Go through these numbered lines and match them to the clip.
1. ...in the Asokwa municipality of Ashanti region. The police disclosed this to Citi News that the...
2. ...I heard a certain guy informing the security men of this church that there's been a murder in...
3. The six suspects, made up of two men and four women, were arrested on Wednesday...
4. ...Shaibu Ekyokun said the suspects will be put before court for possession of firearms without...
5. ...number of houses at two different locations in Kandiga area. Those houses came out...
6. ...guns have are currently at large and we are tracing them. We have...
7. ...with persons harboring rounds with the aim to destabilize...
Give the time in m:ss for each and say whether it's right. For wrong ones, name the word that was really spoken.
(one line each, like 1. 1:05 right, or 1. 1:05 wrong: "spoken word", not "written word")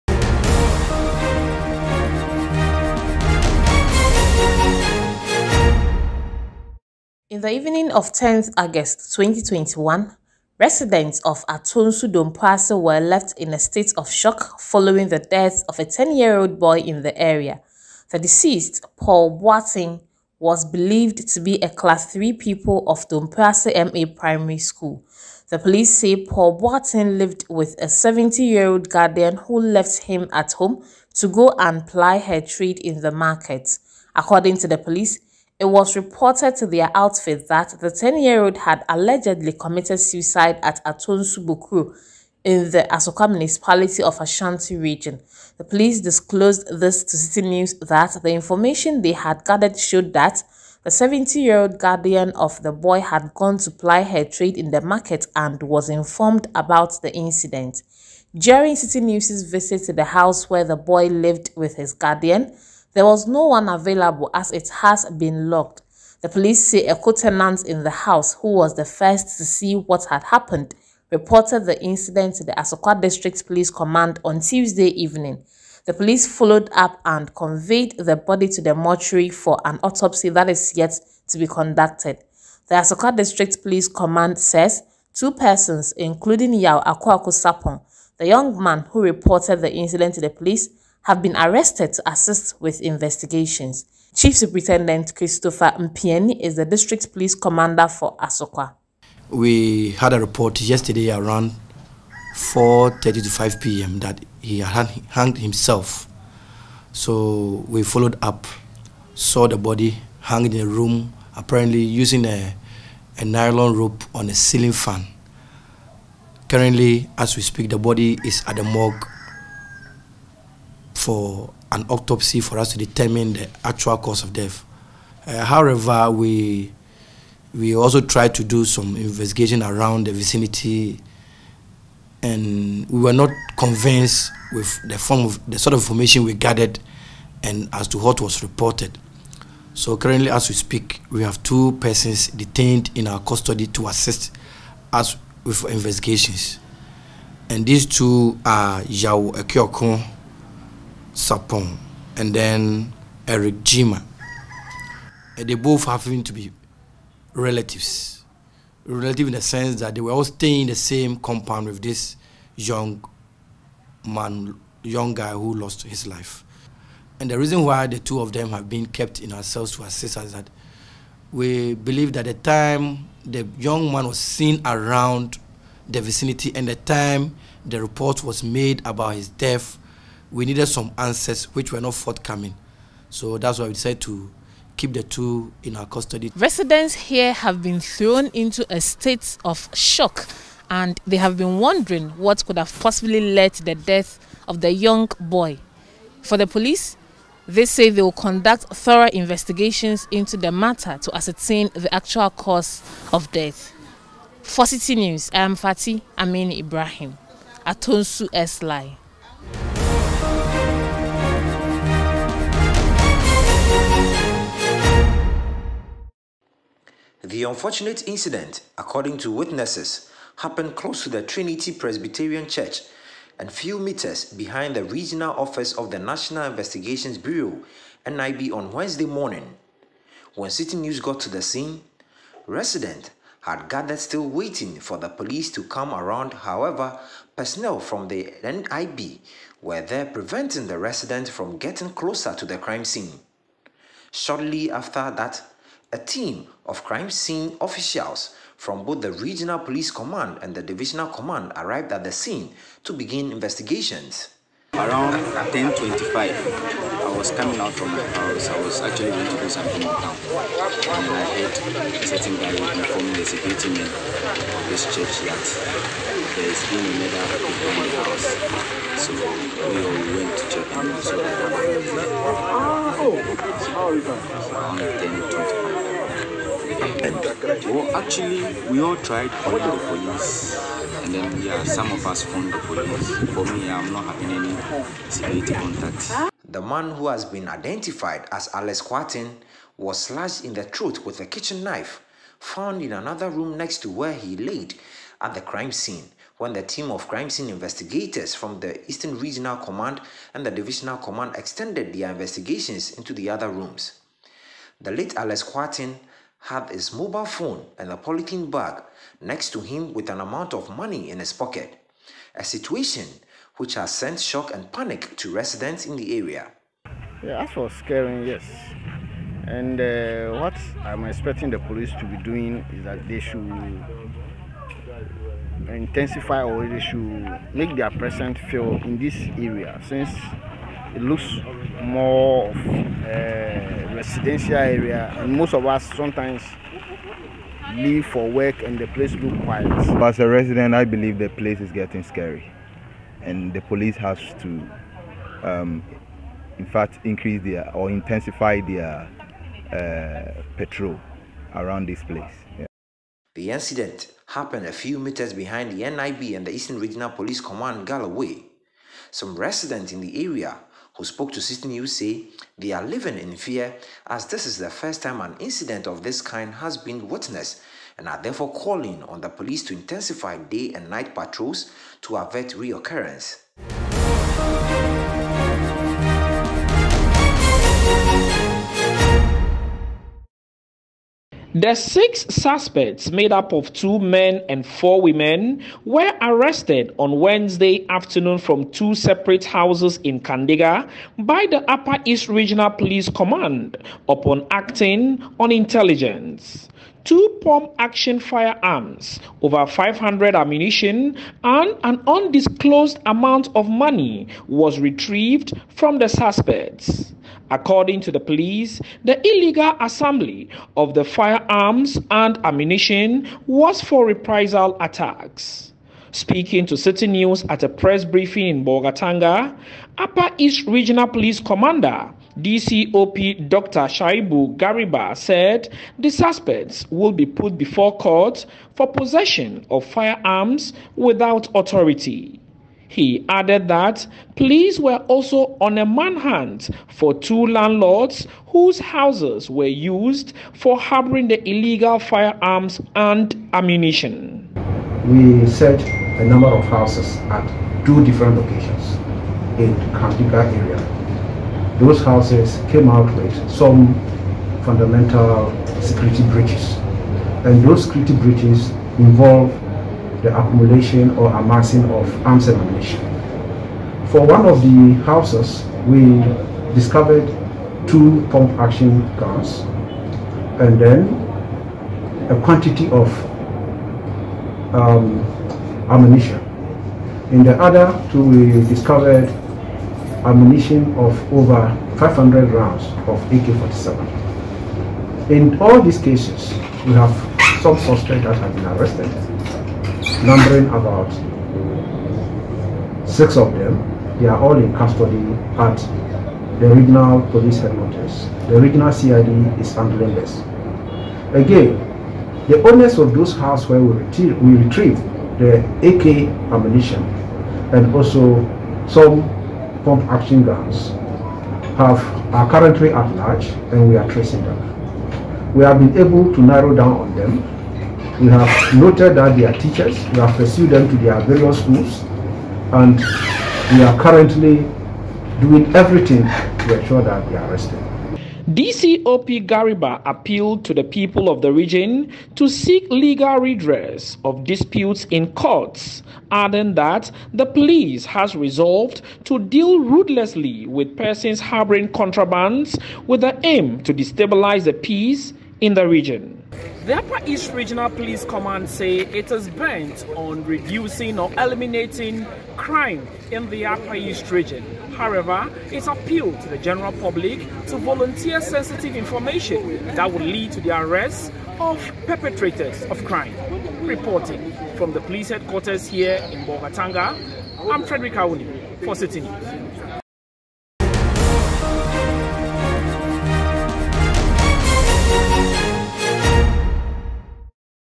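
1. 0:42 right
2. 4:21 right
3. 6:21 right
4. 7:03 wrong: "Gariba", not "Ekyokun"
5. 7:26 right
6. 8:30 right
7. 9:00 wrong: "contrabands", not "rounds".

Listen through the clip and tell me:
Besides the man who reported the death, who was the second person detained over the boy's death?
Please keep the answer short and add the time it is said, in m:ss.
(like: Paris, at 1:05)
Eric Jima, at 2:33.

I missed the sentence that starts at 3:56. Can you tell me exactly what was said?
However, personnel from the NIB were there preventing the residents from getting closer to the crime scene.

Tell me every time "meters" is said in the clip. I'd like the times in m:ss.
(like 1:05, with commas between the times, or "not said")
3:43, 5:54.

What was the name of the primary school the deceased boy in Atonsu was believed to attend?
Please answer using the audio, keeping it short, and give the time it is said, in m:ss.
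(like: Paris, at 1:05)
Dompase MA Primary School, at 0:23.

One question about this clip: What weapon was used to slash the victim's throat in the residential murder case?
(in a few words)
kitchen knife.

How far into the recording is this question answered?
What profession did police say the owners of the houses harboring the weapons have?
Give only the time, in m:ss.
8:39.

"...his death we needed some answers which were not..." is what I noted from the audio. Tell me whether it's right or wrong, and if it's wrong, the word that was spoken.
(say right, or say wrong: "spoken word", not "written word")
right.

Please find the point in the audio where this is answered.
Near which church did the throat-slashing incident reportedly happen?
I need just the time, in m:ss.
3:41.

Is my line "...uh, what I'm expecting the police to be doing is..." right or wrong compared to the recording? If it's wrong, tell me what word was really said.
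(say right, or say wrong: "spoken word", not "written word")
right.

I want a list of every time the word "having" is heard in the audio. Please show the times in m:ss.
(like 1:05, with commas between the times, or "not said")
4:44.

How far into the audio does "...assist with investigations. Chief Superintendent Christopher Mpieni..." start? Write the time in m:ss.
1:32.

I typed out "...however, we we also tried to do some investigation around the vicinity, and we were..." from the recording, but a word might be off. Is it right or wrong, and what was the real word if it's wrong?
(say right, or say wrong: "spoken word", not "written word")
right.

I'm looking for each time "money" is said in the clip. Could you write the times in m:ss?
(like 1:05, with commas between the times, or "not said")
5:10, 6:43.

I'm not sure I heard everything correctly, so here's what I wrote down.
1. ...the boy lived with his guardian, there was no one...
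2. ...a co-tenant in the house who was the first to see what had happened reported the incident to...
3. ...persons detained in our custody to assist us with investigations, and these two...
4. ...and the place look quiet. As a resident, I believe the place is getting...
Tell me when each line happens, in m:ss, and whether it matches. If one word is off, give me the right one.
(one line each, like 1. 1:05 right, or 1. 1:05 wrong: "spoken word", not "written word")
1. 1:00 right
2. 1:06 right
3. 2:21 right
4. 5:38 right.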